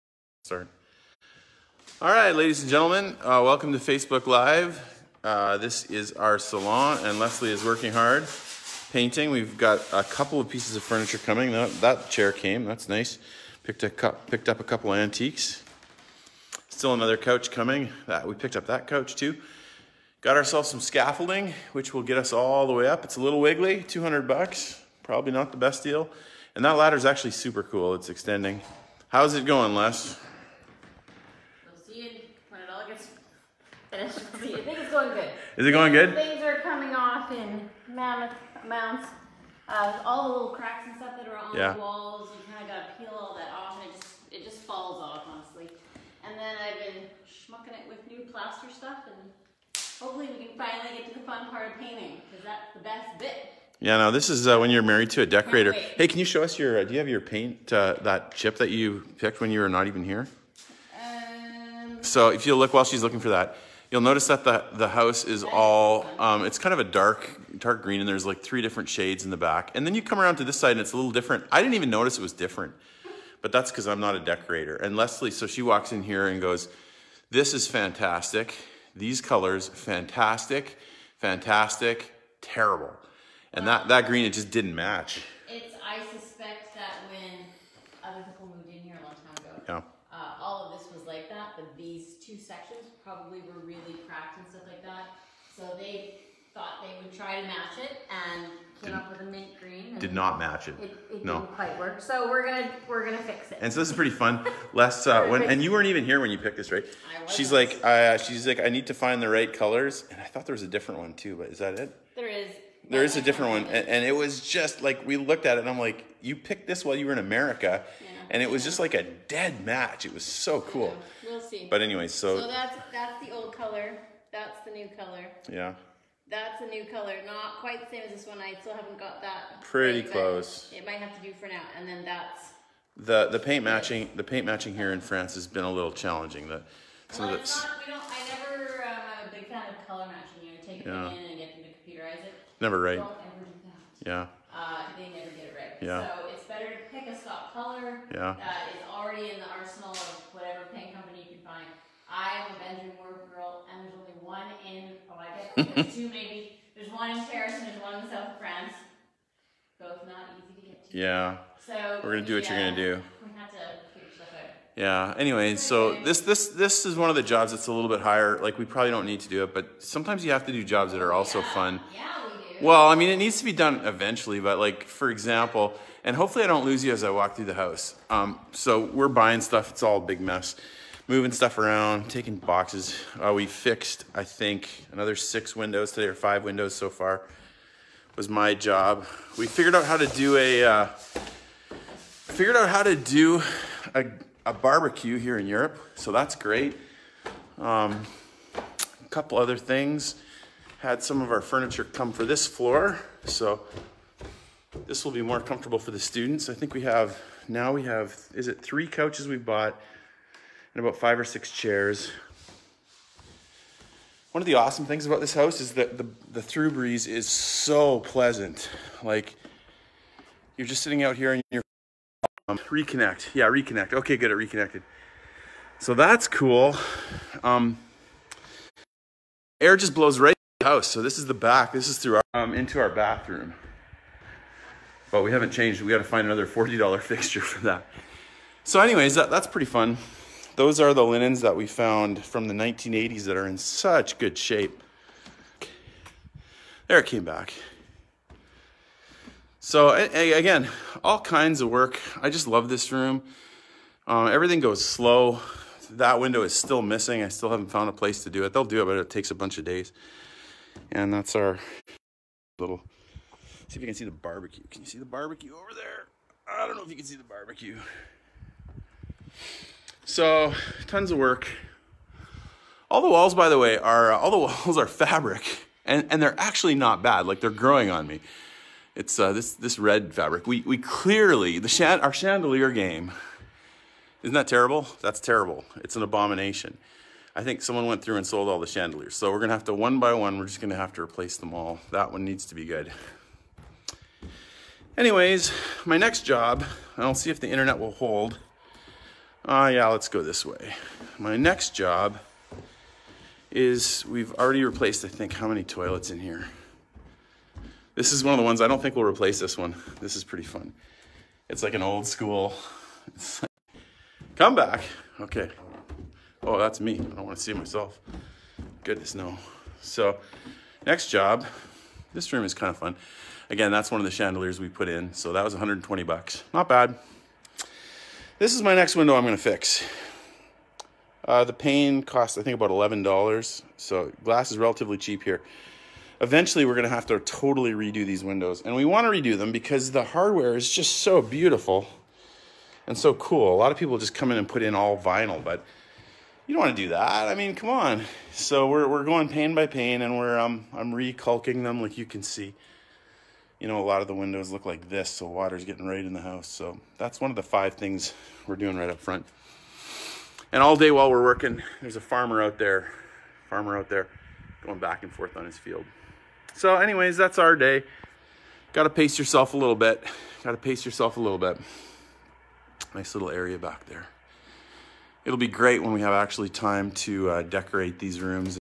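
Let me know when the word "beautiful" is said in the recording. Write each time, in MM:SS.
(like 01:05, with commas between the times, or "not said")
05:41.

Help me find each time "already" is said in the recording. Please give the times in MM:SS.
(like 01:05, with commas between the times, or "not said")
02:28, 05:04.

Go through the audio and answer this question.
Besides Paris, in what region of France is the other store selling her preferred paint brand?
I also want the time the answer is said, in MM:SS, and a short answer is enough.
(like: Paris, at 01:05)
south of France, at 02:38.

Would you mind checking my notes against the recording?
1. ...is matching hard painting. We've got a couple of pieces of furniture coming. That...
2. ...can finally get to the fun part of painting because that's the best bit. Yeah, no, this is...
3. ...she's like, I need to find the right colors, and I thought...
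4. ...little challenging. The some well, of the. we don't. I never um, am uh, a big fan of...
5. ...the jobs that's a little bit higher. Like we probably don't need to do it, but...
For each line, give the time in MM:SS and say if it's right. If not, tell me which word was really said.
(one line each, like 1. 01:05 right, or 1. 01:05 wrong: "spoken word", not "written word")
1. 00:07 wrong: "working", not "matching"
2. 00:50 right
3. 01:48 right
4. 02:15 right
5. 02:47 right.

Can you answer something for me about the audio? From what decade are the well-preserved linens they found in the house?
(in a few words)
1980s.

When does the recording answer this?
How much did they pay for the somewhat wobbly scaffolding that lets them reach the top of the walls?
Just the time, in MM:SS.
00:23.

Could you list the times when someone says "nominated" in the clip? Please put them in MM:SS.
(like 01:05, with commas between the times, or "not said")
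not said.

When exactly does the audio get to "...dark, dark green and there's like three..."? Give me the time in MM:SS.
01:06.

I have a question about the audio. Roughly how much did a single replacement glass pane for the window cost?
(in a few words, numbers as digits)
$11.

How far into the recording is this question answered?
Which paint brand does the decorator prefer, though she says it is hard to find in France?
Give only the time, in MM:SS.
02:32.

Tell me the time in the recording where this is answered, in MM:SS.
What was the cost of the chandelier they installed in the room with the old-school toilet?
05:25.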